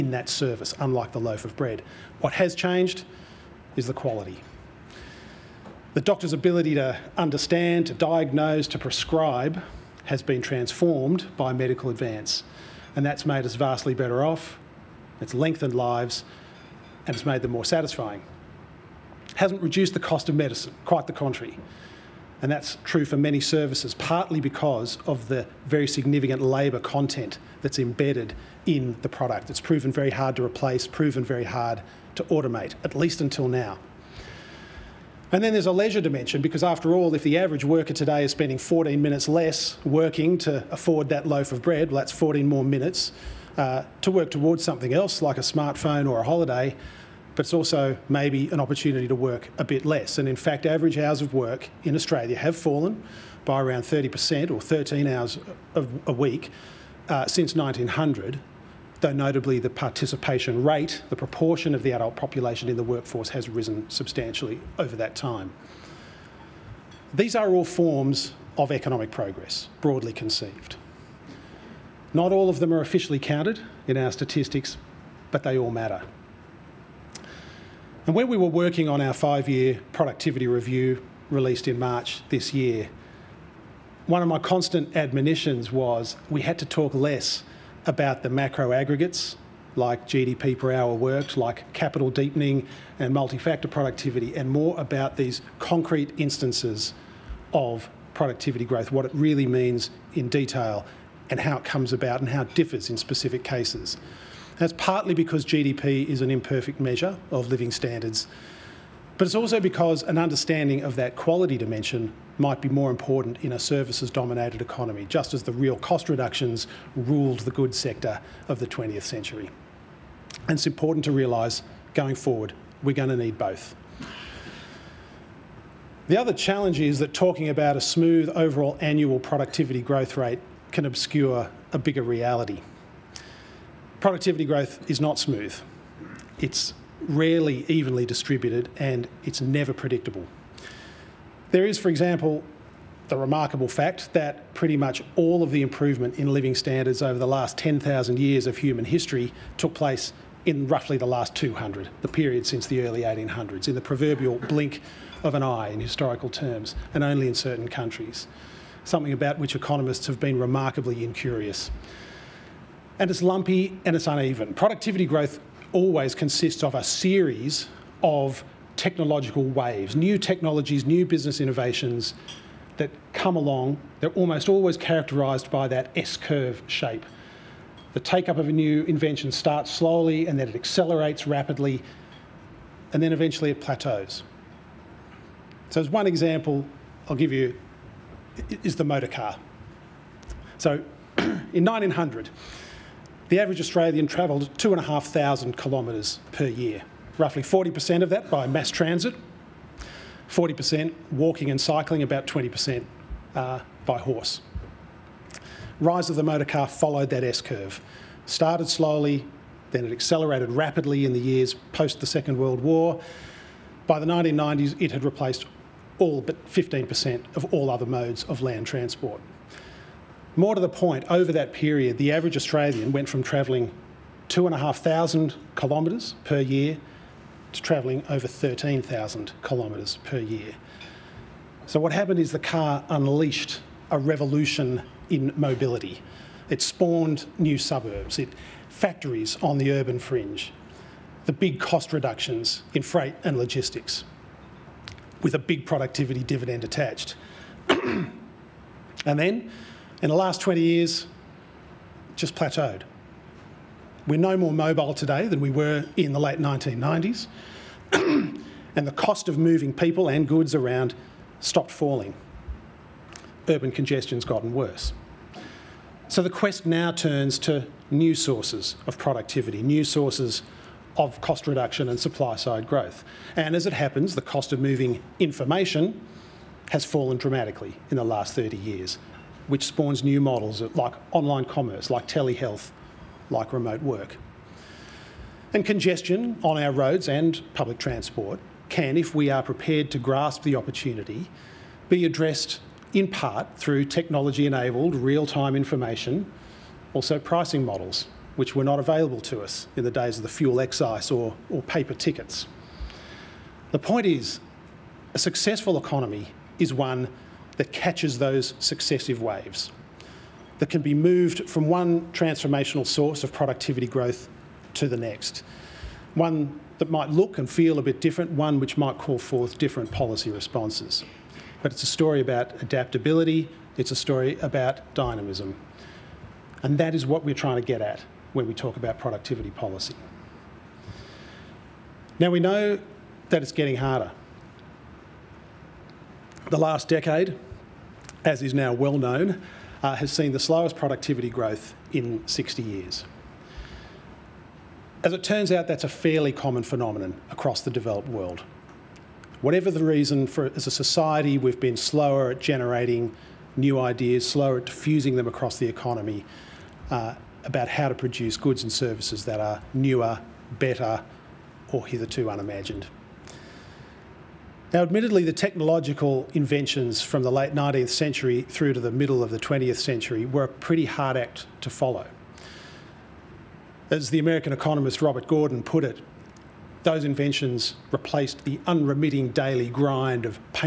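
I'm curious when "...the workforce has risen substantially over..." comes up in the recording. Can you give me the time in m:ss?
1:02.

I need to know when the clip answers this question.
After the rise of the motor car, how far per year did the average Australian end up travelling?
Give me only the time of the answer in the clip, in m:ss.
3:48.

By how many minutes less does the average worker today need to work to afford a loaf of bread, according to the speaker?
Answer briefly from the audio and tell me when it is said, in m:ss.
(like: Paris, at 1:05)
14, at 0:38.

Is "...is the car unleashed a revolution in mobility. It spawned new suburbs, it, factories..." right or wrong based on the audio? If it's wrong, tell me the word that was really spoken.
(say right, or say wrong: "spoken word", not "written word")
right.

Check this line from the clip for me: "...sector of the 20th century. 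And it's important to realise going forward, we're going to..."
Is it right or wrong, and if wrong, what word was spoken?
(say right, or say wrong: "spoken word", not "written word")
right.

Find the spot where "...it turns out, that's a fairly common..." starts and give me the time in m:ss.
5:45.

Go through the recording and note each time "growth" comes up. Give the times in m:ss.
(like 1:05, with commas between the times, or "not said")
1:38, 2:09, 2:14, 2:45, 4:32, 5:13, 5:41.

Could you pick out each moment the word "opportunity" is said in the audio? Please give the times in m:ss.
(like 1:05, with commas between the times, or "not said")
0:48, 4:50.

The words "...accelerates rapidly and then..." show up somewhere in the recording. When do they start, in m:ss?
3:00.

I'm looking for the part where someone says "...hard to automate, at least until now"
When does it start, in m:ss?
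0:31.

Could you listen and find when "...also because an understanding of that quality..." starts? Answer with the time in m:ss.
1:49.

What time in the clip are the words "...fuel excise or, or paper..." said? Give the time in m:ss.
5:00.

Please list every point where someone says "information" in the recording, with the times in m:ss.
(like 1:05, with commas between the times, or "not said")
4:35, 4:55.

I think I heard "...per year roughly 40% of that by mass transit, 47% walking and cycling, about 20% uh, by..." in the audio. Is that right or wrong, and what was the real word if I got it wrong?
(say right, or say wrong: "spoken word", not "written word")
wrong: "40", not "47".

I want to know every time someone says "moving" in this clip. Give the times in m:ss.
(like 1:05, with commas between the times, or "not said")
4:19, 4:34.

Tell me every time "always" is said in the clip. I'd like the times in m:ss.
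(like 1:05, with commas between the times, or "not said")
2:45, 2:54.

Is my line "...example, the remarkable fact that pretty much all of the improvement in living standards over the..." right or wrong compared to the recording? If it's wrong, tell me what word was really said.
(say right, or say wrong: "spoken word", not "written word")
right.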